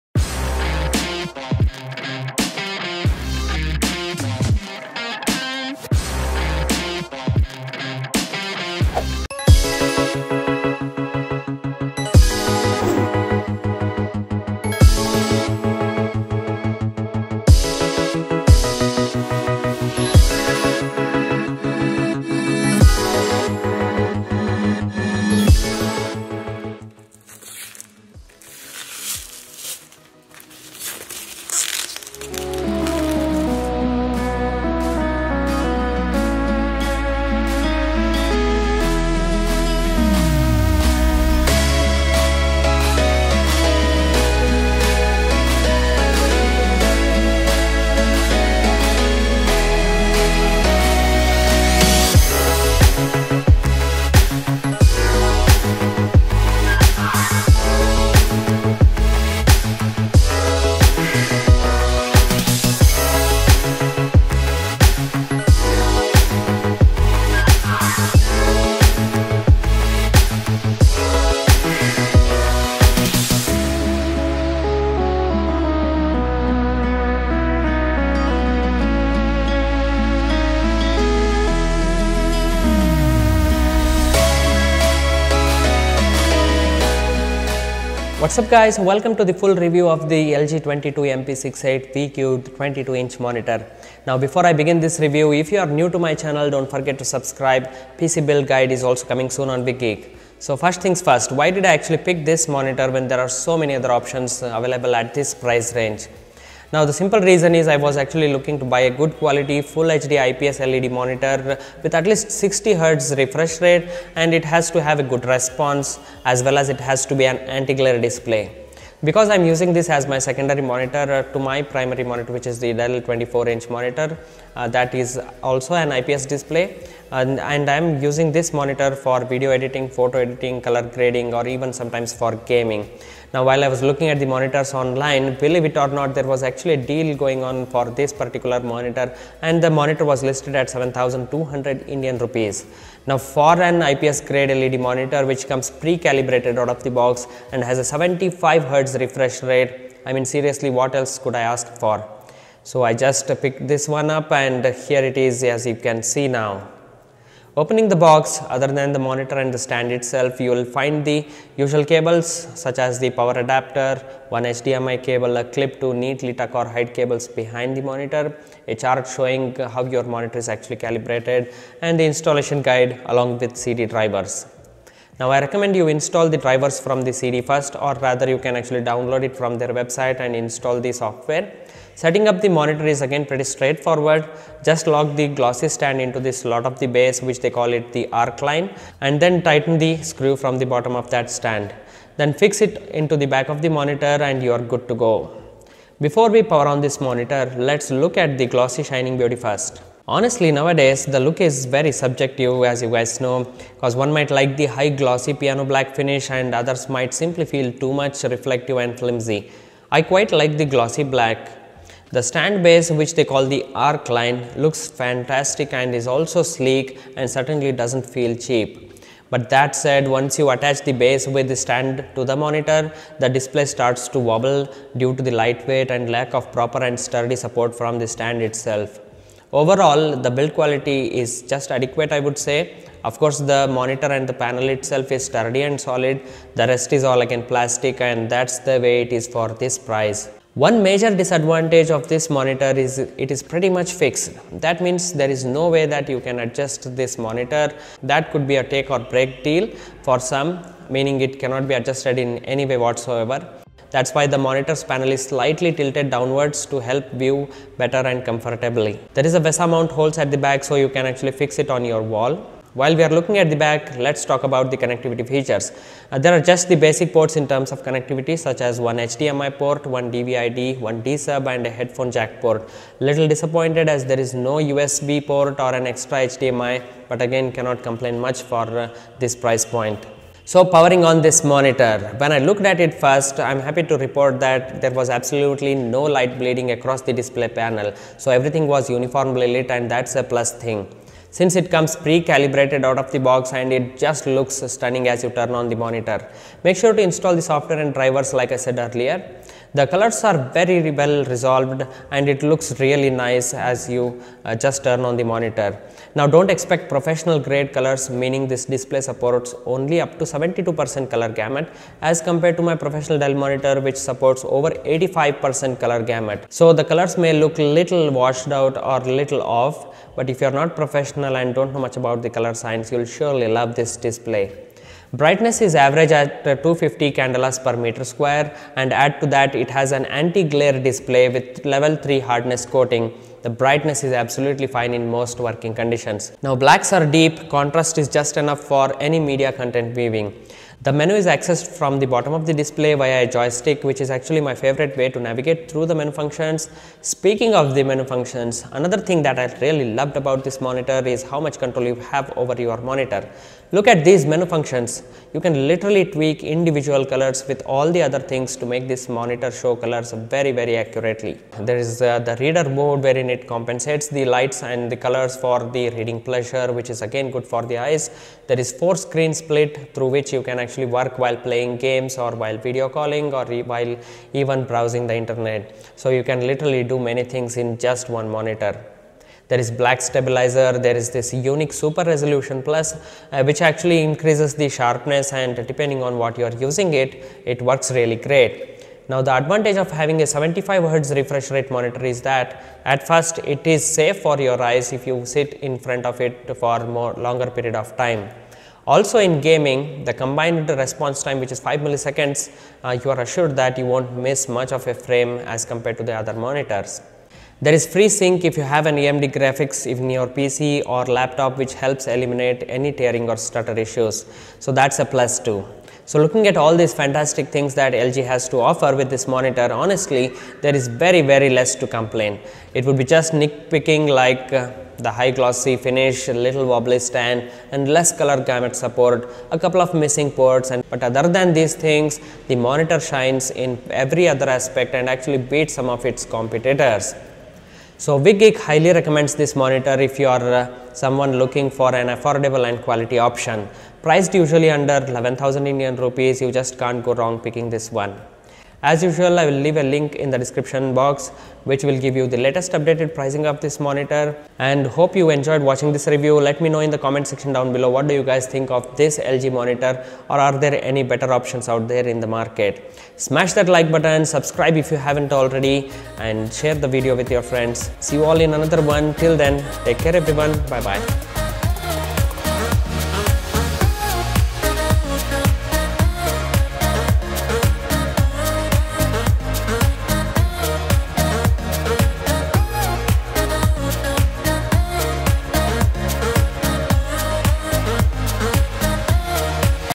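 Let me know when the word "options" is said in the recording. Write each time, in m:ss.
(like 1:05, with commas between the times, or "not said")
1:43, 7:23, 7:41.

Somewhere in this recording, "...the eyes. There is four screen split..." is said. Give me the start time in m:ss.
6:07.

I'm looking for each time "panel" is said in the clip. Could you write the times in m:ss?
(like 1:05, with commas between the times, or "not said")
3:54, 4:14, 4:47.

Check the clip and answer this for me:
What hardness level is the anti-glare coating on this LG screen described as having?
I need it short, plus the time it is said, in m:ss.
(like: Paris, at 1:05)
level 3, at 5:31.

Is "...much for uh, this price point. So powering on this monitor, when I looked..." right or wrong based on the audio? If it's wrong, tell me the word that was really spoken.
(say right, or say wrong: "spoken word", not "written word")
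right.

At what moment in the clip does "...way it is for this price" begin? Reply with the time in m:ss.
3:58.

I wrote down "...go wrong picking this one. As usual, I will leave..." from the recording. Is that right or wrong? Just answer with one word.
right.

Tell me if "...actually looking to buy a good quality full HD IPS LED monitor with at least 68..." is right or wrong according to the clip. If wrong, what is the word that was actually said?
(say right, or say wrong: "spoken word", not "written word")
wrong: "60", not "68".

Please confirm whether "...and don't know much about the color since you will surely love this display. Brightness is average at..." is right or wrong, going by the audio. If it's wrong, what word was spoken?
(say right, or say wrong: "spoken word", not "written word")
wrong: "science", not "since".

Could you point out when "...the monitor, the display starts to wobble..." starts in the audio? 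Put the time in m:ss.
3:42.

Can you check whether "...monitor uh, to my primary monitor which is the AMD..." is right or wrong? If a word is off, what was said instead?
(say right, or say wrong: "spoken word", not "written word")
wrong: "Dell", not "AMD".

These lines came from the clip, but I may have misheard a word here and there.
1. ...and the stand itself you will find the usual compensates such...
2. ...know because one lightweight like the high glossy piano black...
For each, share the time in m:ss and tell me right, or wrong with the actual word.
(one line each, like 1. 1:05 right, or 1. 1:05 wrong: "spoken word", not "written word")
1. 2:39 wrong: "cables", not "compensates"
2. 3:23 wrong: "might", not "lightweight".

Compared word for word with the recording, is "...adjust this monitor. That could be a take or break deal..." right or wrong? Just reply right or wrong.
right.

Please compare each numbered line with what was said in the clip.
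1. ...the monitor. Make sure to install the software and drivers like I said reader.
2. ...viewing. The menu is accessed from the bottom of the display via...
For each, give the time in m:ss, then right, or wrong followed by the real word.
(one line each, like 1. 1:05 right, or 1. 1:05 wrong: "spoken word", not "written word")
1. 4:55 wrong: "earlier", not "reader"
2. 5:39 right.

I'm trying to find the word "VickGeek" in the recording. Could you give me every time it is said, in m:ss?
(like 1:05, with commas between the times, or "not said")
1:39, 7:18.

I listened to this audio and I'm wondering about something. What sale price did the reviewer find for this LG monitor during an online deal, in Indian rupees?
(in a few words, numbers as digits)
7200.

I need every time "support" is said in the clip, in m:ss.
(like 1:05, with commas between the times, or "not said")
3:47, 5:08, 5:13, 7:08.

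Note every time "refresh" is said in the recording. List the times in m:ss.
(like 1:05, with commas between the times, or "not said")
1:53, 2:28, 6:31.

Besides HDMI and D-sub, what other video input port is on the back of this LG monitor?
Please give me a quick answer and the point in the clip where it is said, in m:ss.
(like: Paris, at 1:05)
DVI-D, at 4:30.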